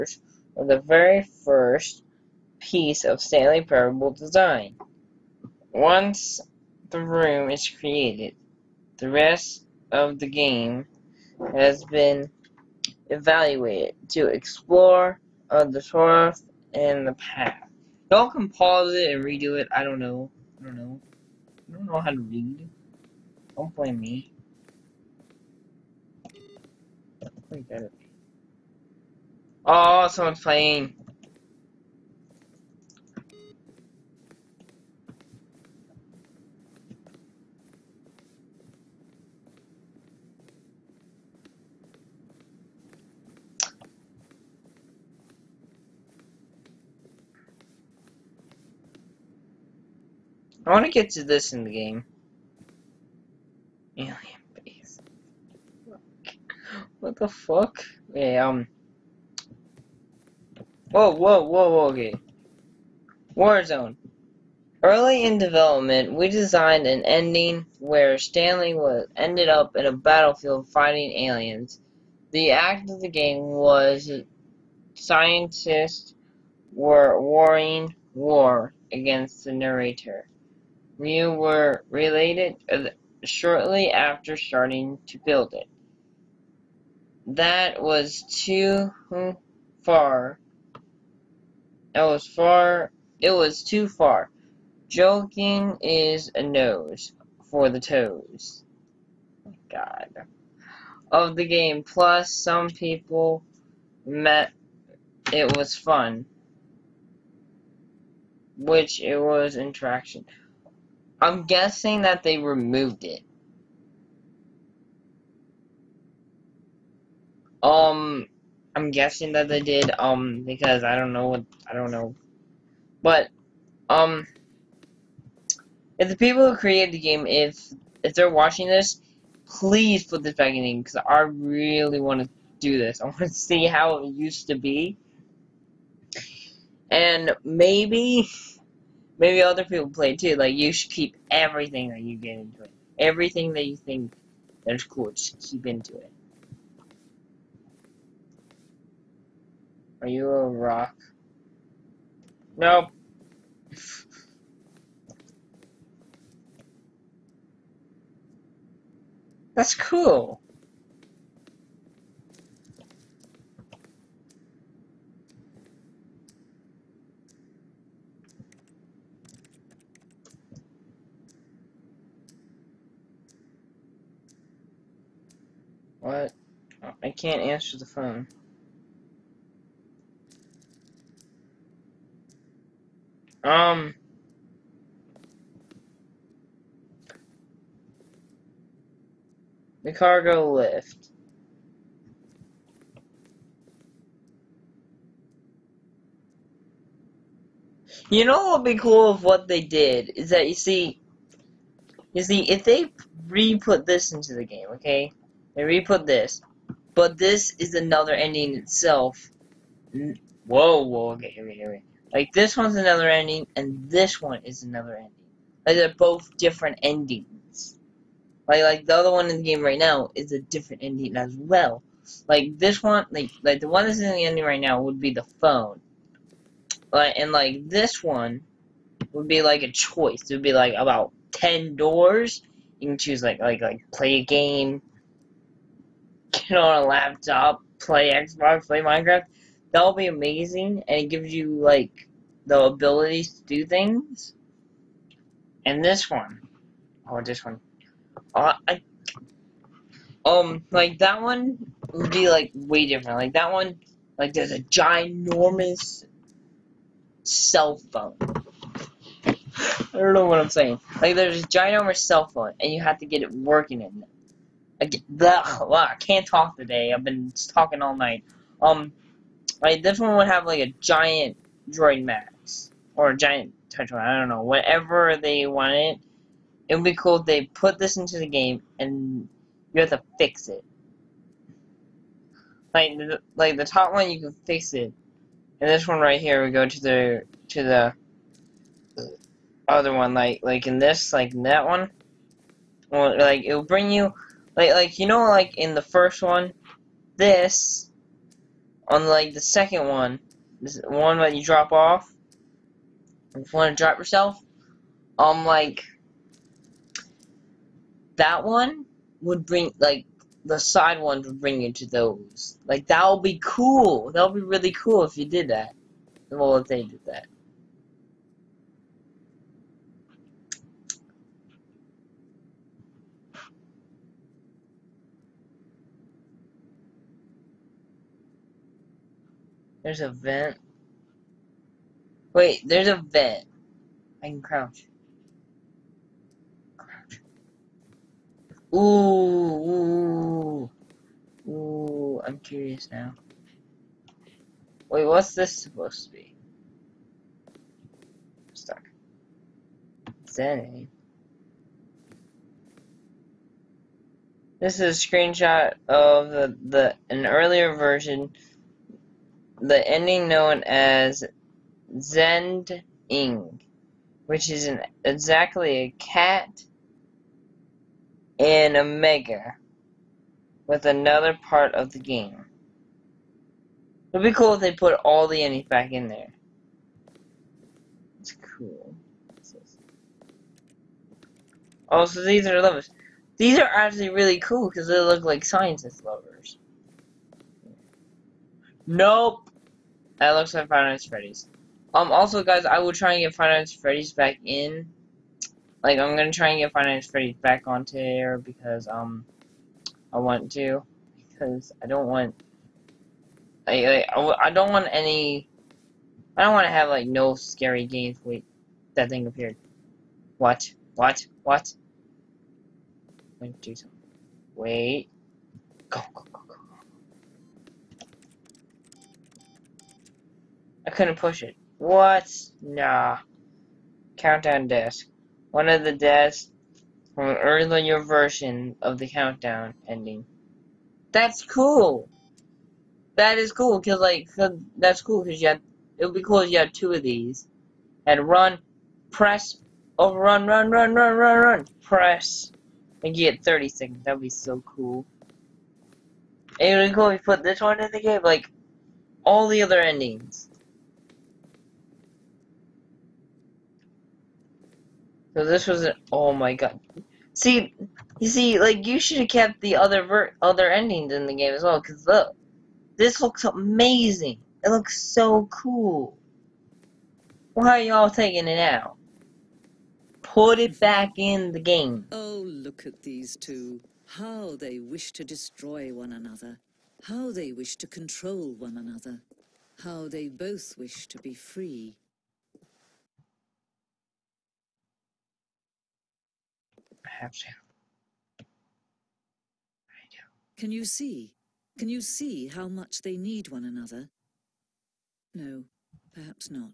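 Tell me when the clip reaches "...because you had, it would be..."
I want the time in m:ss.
7:15.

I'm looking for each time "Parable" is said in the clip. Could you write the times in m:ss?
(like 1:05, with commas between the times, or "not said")
0:03.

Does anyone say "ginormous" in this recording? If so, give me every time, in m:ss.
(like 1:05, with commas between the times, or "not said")
4:14, 4:21.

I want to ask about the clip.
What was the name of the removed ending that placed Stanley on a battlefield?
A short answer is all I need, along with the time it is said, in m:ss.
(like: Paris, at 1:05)
Warzone, at 1:03.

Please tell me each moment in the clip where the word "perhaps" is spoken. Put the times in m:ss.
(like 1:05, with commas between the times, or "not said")
8:16.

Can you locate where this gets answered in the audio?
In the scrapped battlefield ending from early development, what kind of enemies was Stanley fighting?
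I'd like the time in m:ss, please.
1:11.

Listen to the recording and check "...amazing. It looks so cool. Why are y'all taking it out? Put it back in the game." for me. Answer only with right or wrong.
right.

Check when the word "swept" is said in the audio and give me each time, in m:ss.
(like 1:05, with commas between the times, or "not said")
not said.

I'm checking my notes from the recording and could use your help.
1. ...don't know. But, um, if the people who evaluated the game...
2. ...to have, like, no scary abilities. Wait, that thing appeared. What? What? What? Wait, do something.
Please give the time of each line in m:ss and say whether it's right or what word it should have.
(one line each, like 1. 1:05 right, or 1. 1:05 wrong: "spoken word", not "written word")
1. 2:01 wrong: "created", not "evaluated"
2. 6:46 wrong: "games", not "abilities".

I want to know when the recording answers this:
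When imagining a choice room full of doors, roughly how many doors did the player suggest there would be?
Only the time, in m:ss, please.
3:50.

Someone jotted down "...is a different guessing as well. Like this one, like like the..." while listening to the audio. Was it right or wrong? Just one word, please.
wrong.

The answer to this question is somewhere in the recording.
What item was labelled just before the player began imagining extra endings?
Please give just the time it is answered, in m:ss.
3:09.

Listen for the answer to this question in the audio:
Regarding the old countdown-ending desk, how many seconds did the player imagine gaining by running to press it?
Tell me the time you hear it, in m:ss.
7:23.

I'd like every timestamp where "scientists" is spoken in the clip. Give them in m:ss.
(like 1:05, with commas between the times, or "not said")
1:14, 6:25.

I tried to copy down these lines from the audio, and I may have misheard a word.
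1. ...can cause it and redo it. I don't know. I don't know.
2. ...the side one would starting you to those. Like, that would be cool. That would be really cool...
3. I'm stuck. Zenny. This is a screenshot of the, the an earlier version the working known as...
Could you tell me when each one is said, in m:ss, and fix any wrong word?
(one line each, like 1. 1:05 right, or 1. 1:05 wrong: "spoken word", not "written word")
1. 0:18 wrong: "pause", not "cause"
2. 5:10 wrong: "bring", not "starting"
3. 5:48 wrong: "ending", not "working".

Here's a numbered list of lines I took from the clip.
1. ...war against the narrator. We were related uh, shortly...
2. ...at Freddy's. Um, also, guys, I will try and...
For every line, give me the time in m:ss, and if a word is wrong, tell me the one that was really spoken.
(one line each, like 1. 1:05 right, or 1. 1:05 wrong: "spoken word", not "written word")
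1. 1:18 right
2. 6:31 right.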